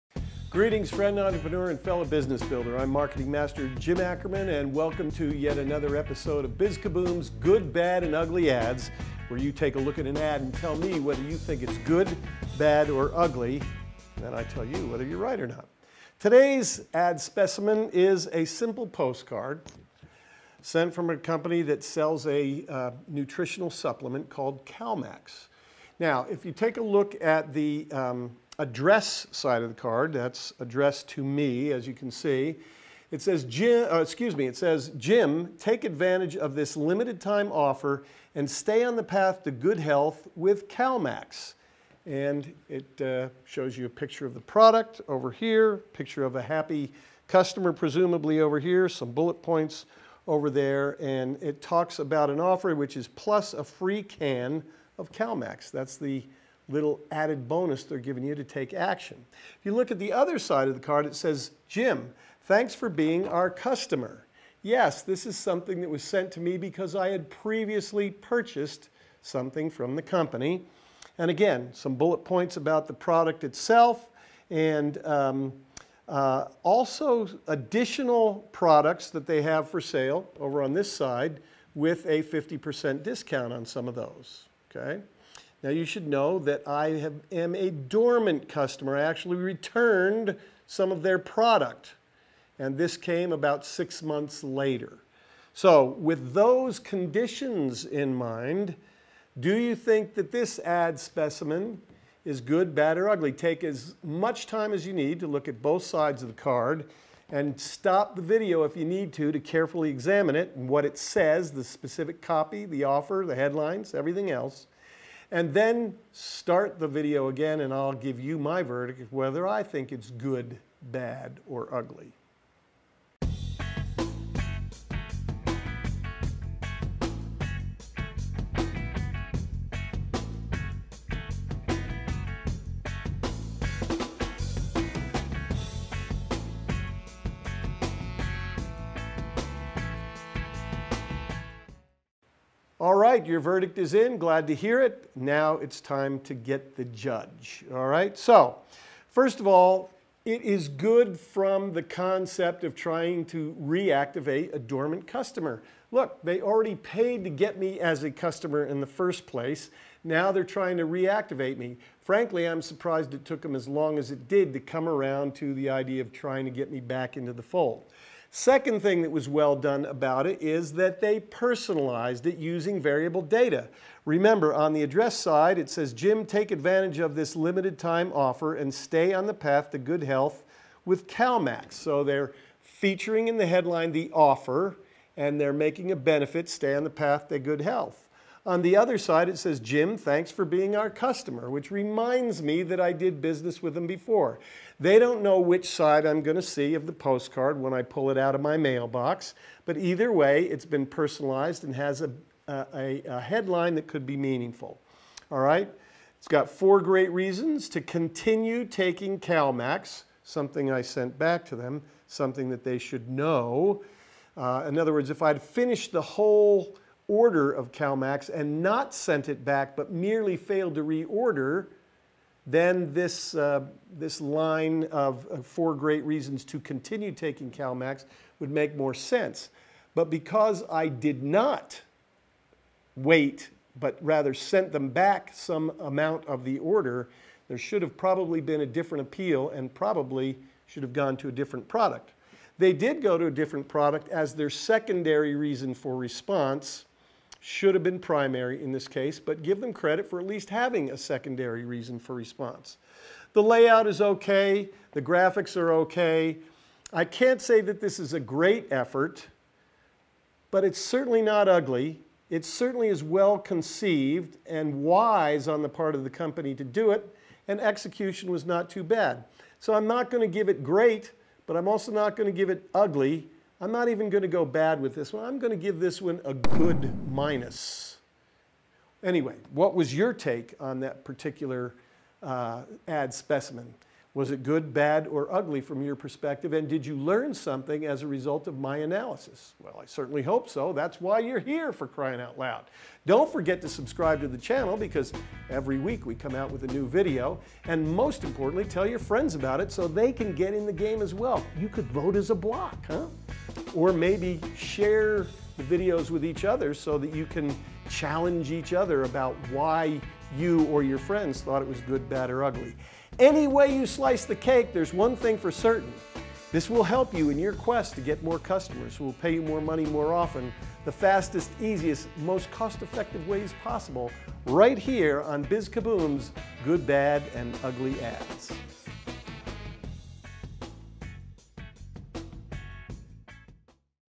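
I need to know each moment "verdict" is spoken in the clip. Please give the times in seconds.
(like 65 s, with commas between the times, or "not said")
118 s, 143 s.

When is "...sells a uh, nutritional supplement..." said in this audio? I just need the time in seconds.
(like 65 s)
21 s.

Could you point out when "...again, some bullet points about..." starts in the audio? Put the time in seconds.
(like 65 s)
71 s.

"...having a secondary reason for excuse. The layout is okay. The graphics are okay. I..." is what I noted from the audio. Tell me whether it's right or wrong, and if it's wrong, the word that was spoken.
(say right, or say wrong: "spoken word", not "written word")
wrong: "response", not "excuse".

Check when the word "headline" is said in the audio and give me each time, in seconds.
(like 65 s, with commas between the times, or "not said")
113 s, 183 s, 203 s.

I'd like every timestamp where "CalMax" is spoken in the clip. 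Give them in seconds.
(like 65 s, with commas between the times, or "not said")
24 s, 40 s, 55 s, 181 s, 209 s, 217 s, 227 s.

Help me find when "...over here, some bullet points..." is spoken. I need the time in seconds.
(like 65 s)
48 s.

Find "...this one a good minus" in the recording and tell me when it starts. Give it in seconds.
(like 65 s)
275 s.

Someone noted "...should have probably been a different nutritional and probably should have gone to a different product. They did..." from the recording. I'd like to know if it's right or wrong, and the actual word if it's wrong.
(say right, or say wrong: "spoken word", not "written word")
wrong: "appeal", not "nutritional".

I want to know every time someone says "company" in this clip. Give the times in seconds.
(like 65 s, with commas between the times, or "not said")
21 s, 70 s, 266 s.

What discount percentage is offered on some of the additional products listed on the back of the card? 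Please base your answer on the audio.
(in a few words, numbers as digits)
50%.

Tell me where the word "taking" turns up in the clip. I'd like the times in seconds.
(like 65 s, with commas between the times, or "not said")
208 s, 227 s.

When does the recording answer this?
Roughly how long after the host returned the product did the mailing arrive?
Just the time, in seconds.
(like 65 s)
93 s.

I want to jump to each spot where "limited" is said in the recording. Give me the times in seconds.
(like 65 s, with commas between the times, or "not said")
36 s, 177 s.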